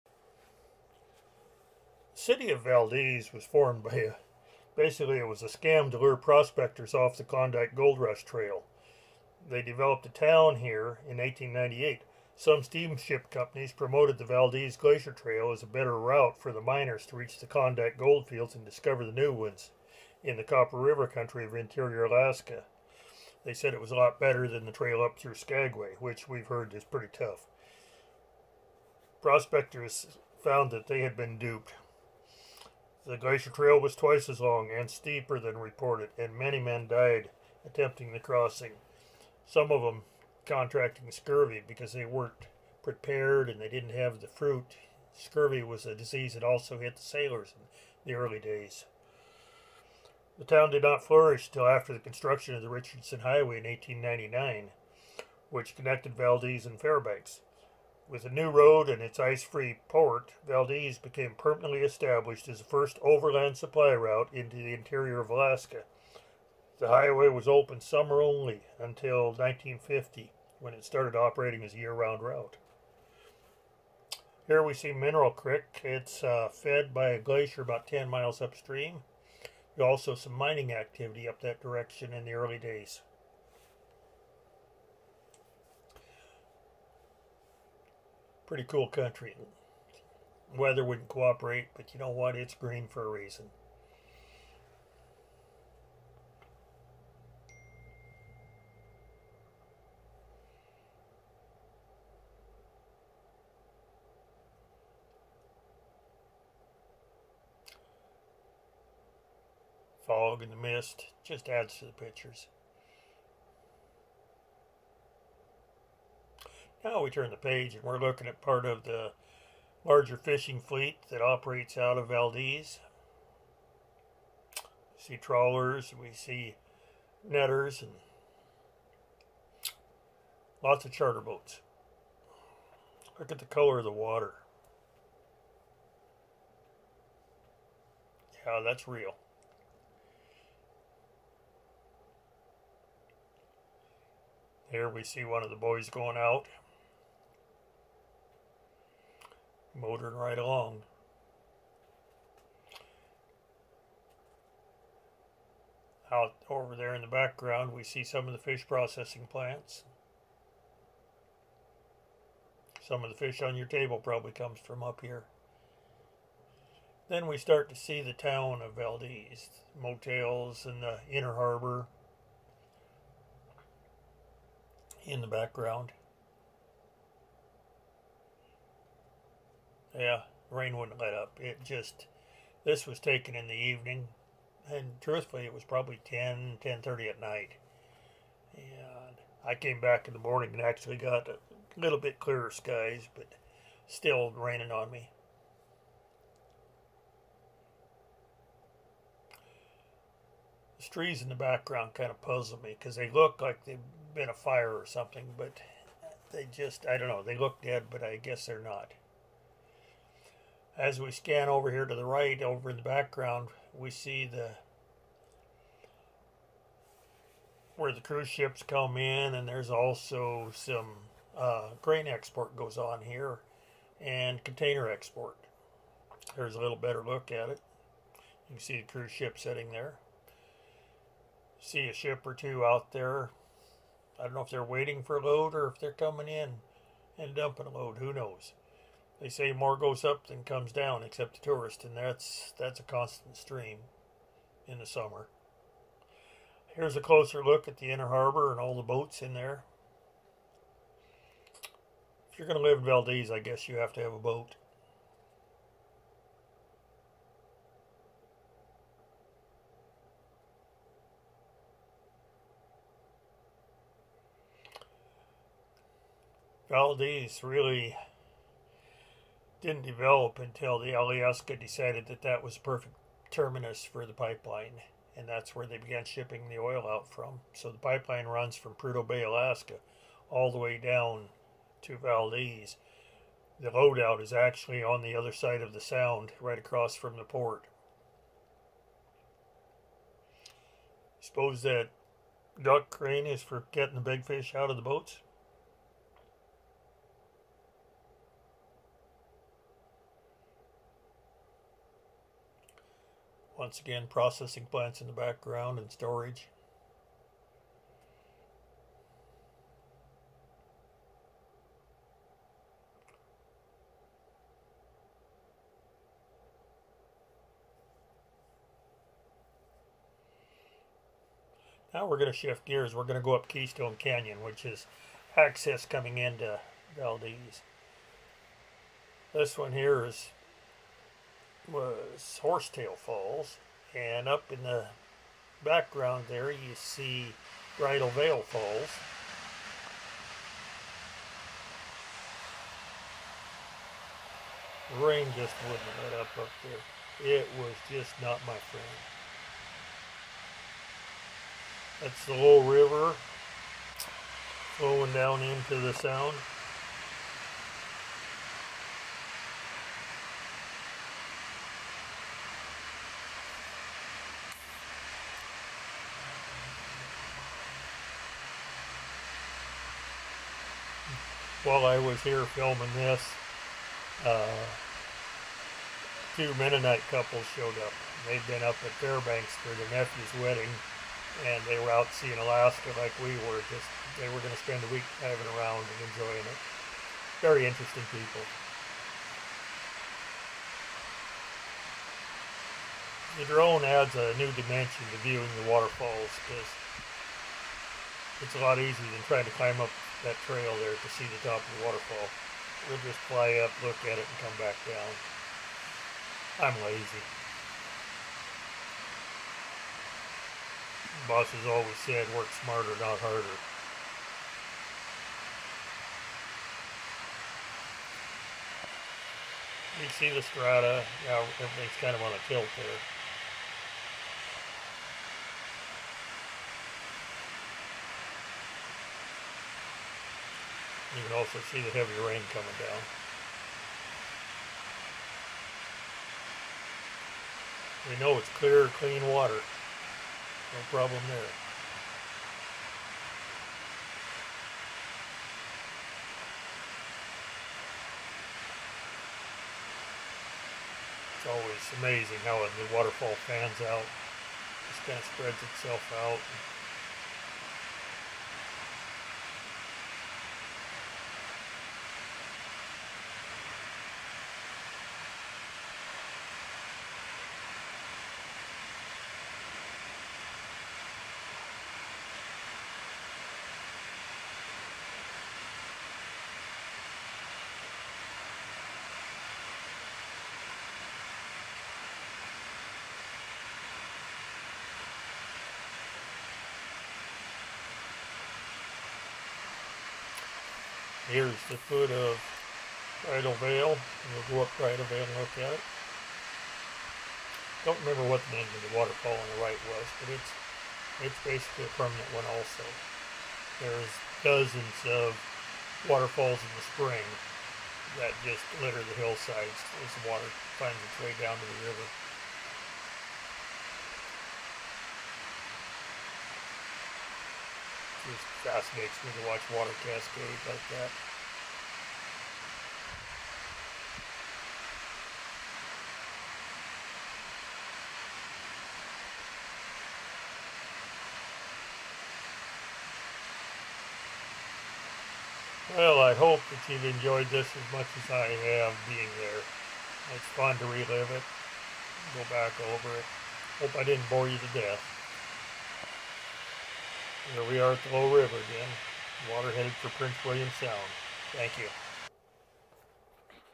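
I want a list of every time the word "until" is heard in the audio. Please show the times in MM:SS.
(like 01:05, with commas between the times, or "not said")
01:08, 04:30.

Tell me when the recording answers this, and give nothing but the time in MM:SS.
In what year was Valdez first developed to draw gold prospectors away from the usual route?
00:11.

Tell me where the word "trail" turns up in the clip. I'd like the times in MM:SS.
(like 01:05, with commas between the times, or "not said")
00:08, 00:15, 00:24, 00:33, 06:40.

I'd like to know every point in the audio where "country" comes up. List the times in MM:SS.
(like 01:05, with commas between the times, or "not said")
00:21, 01:28.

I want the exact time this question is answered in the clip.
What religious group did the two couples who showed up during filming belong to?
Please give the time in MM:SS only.
06:16.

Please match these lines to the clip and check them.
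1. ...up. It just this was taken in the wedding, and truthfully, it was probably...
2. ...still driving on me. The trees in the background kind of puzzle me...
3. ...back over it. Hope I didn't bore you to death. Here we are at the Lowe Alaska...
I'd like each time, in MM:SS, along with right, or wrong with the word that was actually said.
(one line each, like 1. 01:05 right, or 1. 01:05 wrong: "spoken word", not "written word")
1. 03:01 wrong: "evening", not "wedding"
2. 03:13 wrong: "raining", not "driving"
3. 09:02 wrong: "River", not "Alaska".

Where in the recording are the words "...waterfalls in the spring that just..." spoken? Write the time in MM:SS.
08:26.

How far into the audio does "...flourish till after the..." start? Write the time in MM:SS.
00:51.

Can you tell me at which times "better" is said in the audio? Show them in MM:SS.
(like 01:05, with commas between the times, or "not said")
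00:15, 00:24, 03:46.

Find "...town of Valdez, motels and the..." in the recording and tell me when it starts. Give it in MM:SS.
02:48.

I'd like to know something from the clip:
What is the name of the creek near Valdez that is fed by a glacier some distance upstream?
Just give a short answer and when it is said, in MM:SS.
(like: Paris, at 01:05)
Mineral Creek, at 01:14.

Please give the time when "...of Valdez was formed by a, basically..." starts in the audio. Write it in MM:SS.
00:02.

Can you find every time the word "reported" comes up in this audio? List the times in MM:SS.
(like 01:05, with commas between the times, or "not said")
00:35.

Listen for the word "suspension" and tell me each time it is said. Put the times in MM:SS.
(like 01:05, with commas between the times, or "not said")
not said.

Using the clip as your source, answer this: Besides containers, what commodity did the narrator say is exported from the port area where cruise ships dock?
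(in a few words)
Grain.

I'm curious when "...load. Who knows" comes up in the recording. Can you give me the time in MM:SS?
03:57.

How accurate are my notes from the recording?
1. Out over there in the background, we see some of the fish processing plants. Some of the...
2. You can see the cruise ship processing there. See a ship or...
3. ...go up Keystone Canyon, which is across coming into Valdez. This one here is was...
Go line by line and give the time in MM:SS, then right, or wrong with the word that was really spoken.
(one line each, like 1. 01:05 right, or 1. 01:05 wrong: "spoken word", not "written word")
1. 02:36 right
2. 03:48 wrong: "sitting", not "processing"
3. 05:23 wrong: "access", not "across".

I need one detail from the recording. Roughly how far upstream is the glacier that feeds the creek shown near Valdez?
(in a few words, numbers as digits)
10 miles.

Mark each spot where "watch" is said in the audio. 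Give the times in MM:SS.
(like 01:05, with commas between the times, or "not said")
08:39.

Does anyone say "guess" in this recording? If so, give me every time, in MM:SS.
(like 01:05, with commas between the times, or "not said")
03:28, 04:13.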